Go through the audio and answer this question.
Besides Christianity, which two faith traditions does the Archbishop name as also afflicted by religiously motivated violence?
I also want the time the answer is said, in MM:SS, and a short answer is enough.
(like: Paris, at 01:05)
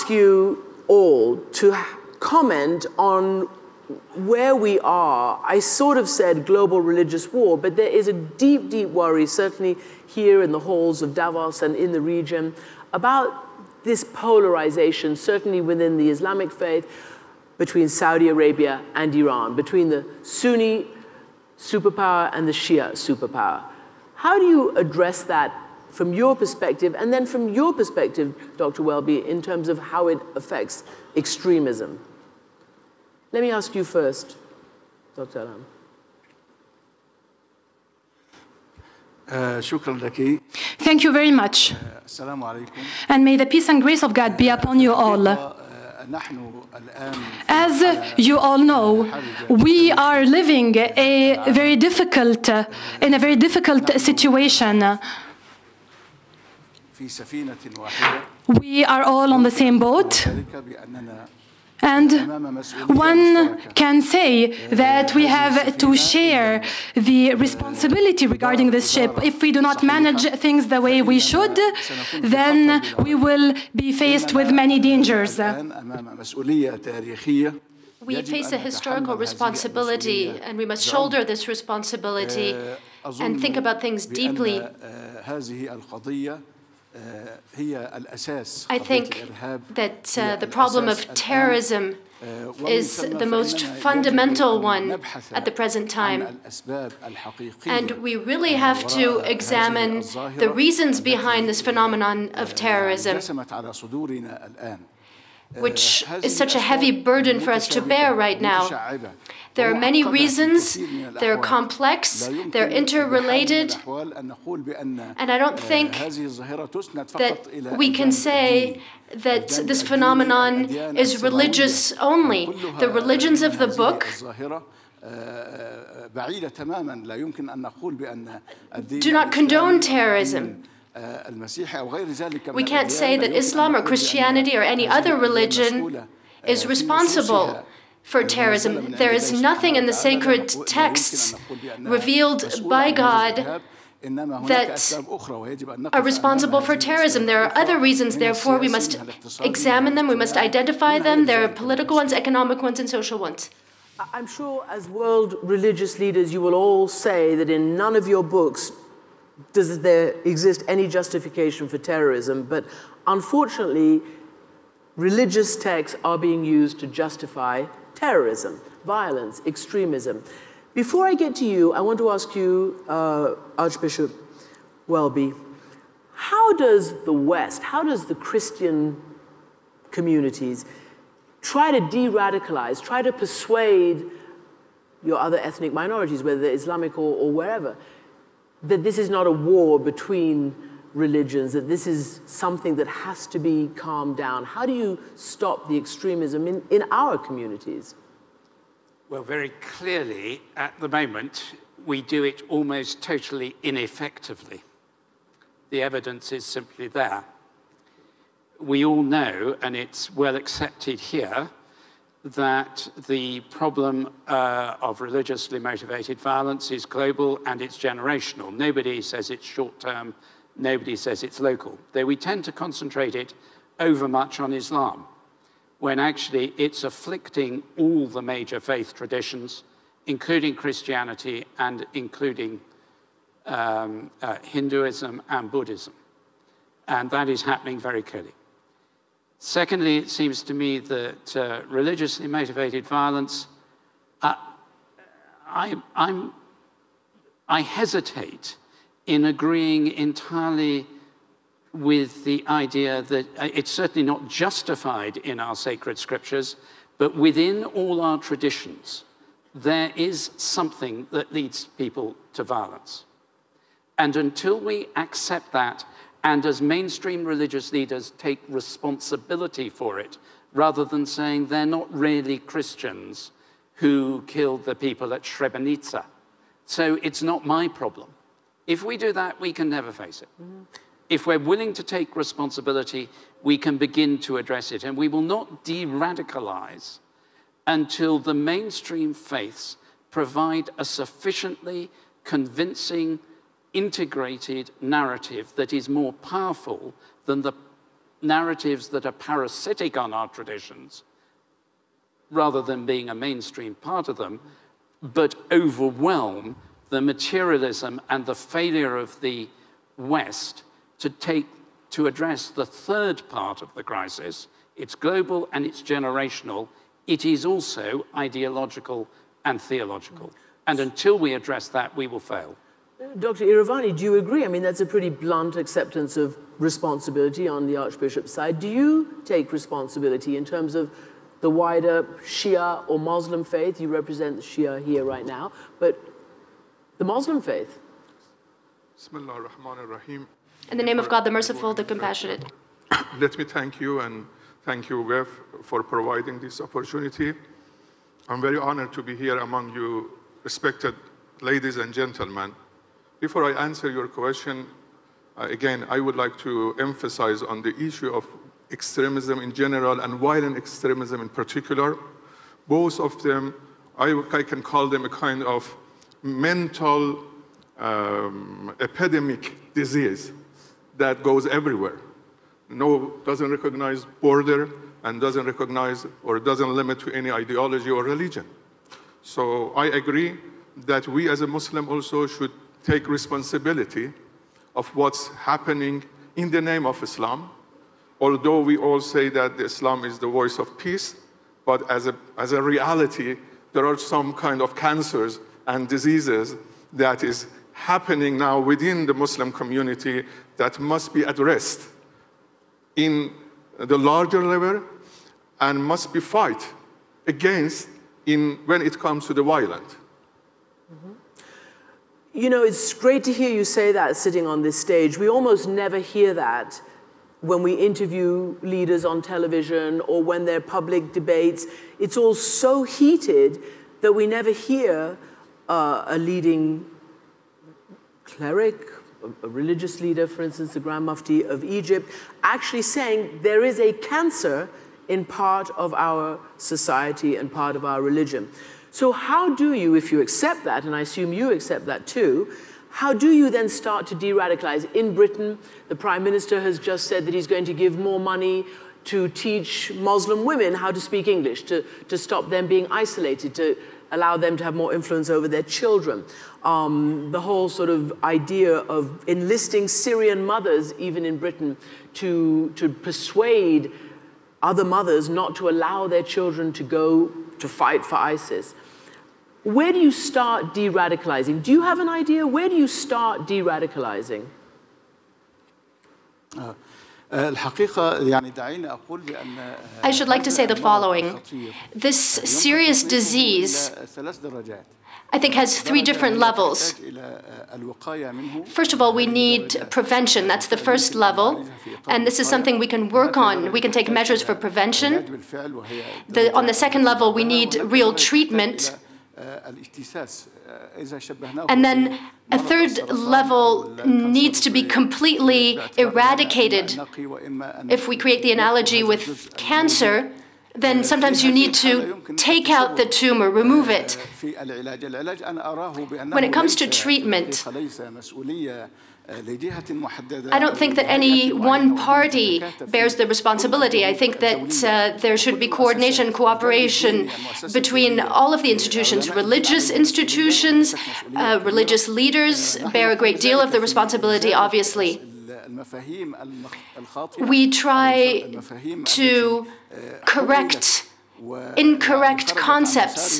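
Hinduism and Buddhism, at 03:54.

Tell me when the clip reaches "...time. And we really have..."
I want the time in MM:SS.
01:35.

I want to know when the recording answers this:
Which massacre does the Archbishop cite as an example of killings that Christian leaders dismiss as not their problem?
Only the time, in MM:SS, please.
04:35.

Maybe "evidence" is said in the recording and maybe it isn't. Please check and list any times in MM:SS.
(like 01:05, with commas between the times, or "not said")
03:25.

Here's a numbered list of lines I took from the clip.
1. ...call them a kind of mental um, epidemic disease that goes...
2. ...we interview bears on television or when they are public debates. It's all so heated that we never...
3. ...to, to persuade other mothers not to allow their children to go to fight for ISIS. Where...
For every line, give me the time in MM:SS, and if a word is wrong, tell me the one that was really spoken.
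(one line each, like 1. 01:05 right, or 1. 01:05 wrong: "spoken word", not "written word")
1. 06:04 right
2. 06:57 wrong: "leaders", not "bears"
3. 07:42 right.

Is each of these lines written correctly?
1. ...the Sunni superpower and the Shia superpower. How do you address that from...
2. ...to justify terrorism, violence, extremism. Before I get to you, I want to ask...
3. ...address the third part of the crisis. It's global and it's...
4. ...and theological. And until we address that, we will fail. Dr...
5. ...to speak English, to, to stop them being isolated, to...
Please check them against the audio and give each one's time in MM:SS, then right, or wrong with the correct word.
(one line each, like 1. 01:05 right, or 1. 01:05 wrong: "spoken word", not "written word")
1. 00:19 right
2. 02:46 right
3. 05:12 right
4. 05:19 right
5. 07:30 right.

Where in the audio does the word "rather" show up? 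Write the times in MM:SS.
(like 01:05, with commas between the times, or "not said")
04:30, 05:02.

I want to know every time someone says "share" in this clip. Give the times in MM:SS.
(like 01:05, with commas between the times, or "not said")
01:05.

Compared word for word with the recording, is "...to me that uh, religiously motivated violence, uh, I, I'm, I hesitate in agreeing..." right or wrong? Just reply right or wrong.
right.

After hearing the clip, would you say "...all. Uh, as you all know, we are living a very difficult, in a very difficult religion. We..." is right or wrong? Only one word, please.
wrong.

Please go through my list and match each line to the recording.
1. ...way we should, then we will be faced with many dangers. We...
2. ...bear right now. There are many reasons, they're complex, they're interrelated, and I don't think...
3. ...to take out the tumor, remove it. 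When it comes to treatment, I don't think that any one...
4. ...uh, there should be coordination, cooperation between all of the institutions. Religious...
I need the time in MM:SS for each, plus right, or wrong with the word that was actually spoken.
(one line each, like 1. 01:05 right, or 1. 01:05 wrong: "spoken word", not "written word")
1. 01:10 right
2. 01:47 right
3. 08:31 right
4. 08:44 right.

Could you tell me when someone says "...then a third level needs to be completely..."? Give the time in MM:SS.
08:21.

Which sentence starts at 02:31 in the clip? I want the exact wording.
There are political ones, economic ones, and social ones.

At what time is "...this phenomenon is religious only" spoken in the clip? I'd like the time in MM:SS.
01:59.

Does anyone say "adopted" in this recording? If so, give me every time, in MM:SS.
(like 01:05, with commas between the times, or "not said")
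not said.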